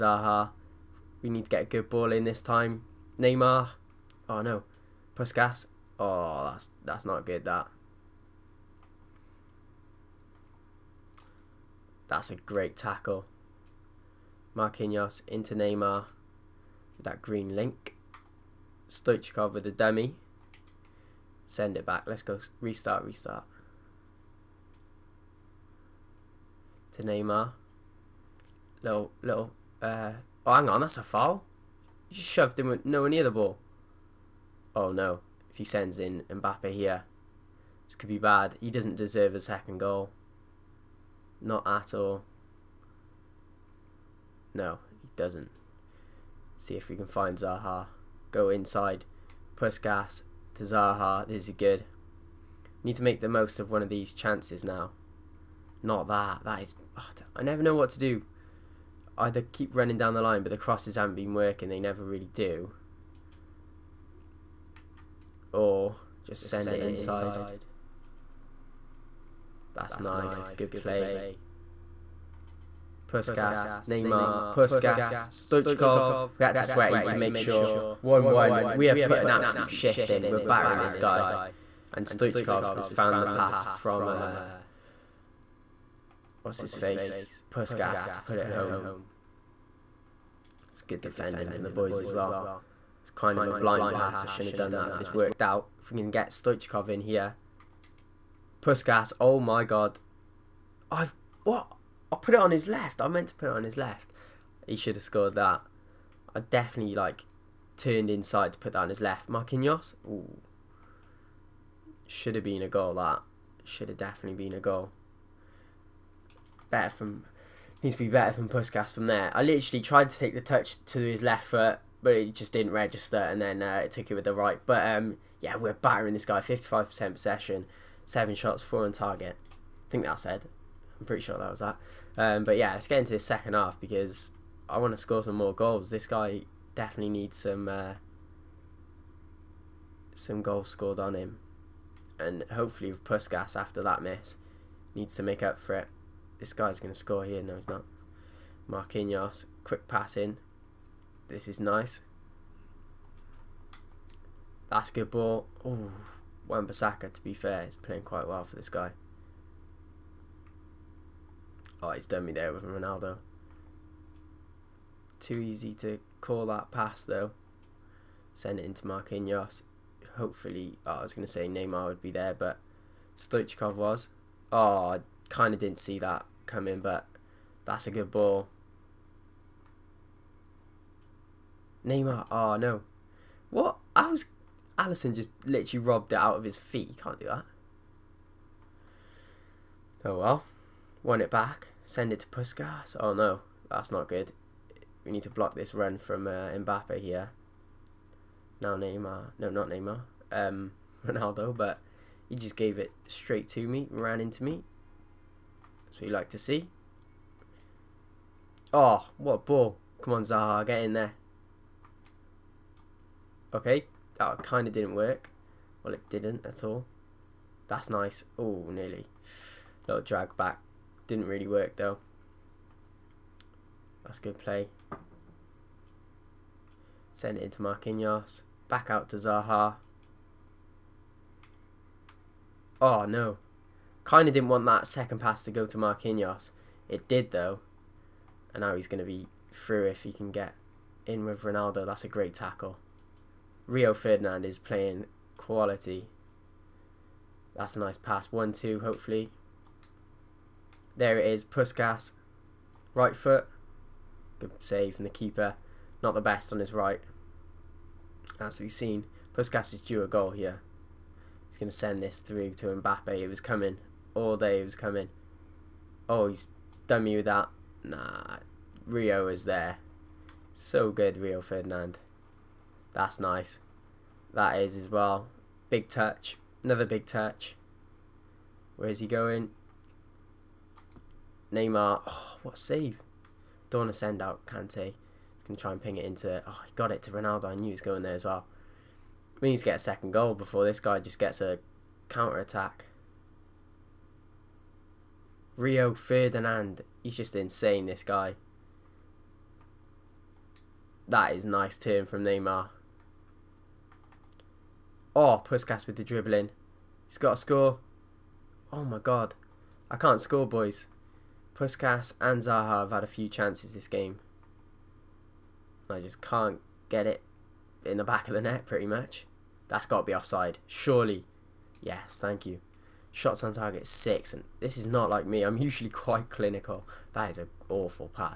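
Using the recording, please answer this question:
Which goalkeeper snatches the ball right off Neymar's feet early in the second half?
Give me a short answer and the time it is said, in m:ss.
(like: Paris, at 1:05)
Alisson, at 3:04.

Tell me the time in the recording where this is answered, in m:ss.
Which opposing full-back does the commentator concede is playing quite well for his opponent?
2:36.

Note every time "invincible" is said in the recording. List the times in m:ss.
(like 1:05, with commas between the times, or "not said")
not said.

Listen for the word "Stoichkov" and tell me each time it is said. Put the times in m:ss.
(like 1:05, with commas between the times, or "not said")
0:18, 1:15, 1:22, 1:36, 2:53.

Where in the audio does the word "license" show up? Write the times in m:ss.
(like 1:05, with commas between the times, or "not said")
not said.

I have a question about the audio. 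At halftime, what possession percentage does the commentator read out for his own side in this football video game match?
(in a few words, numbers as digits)
55%.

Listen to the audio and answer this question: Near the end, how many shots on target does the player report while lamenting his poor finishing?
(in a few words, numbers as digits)
6.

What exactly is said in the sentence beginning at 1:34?
I shouldn't have done that, but it's worked out.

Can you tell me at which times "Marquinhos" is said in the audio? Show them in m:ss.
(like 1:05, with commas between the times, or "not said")
0:14, 1:49, 2:28, 2:48, 3:47, 3:55.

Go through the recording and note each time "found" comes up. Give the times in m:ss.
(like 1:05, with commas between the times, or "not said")
1:22.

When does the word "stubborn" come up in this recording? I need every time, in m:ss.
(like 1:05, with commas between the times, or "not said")
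not said.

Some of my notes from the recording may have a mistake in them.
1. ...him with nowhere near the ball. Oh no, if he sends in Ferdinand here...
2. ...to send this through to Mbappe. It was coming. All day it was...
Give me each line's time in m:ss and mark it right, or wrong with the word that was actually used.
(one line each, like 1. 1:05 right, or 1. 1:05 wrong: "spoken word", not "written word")
1. 0:32 wrong: "Mbappe", not "Ferdinand"
2. 4:21 right.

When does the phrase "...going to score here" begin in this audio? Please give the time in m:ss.
2:26.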